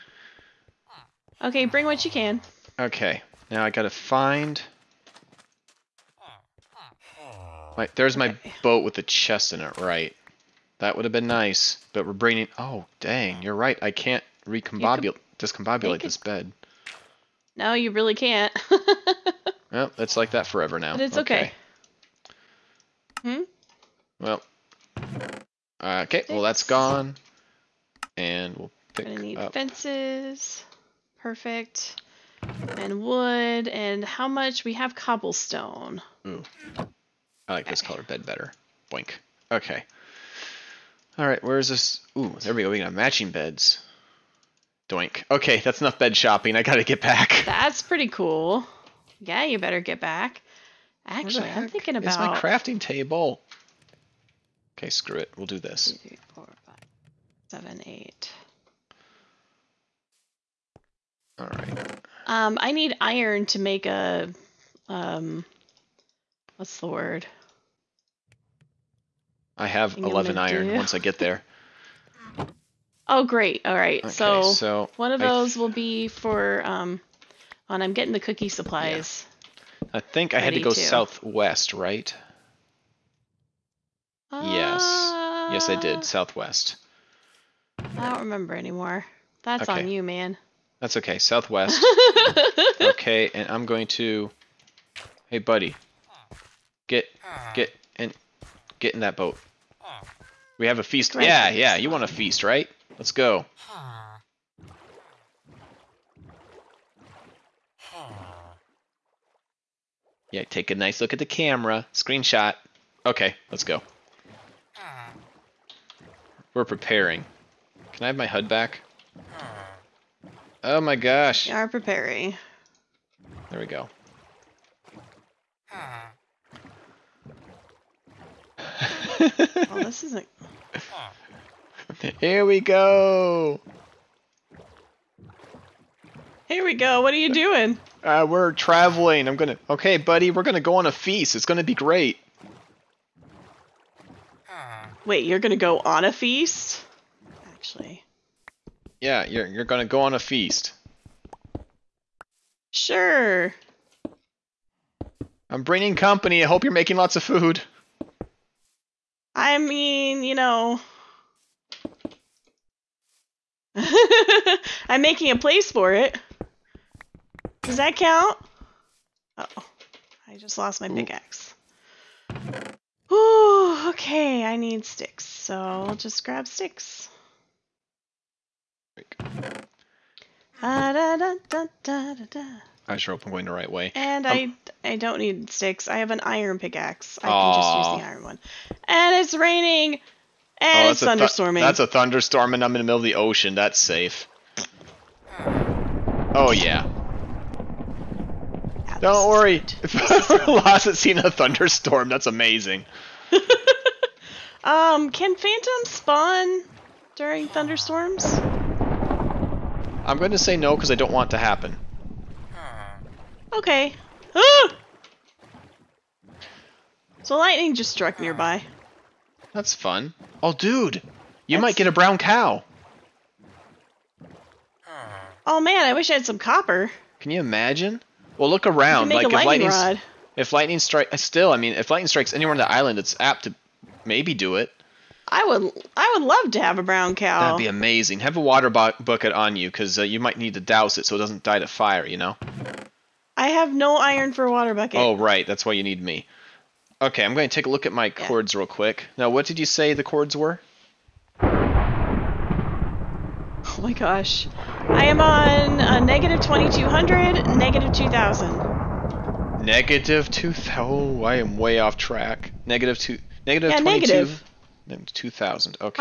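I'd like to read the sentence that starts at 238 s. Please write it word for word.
Have a water bu bucket on you because uh, you might need to douse it so it doesn't die to fire.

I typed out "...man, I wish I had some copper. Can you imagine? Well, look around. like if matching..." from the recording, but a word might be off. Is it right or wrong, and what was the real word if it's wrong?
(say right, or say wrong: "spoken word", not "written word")
wrong: "lightning", not "matching".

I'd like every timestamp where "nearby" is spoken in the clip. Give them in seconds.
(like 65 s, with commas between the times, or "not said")
218 s.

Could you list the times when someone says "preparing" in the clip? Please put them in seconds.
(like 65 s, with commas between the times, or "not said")
116 s, 121 s.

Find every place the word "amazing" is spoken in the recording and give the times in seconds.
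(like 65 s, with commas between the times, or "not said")
202 s, 237 s.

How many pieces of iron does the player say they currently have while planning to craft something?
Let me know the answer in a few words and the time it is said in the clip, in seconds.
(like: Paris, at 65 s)
11, at 69 s.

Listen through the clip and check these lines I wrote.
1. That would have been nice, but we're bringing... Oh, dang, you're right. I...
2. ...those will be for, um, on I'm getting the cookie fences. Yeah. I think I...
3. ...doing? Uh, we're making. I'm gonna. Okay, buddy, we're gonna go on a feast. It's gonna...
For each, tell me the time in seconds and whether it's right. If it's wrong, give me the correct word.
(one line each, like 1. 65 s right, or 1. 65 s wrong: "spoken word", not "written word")
1. 10 s right
2. 75 s wrong: "supplies", not "fences"
3. 137 s wrong: "traveling", not "making".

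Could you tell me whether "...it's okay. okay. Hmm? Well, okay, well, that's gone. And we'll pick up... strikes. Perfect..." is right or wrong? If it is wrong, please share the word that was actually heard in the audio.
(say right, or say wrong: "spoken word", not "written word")
wrong: "fences", not "strikes".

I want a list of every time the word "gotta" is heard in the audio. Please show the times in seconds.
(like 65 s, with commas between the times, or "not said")
3 s, 46 s.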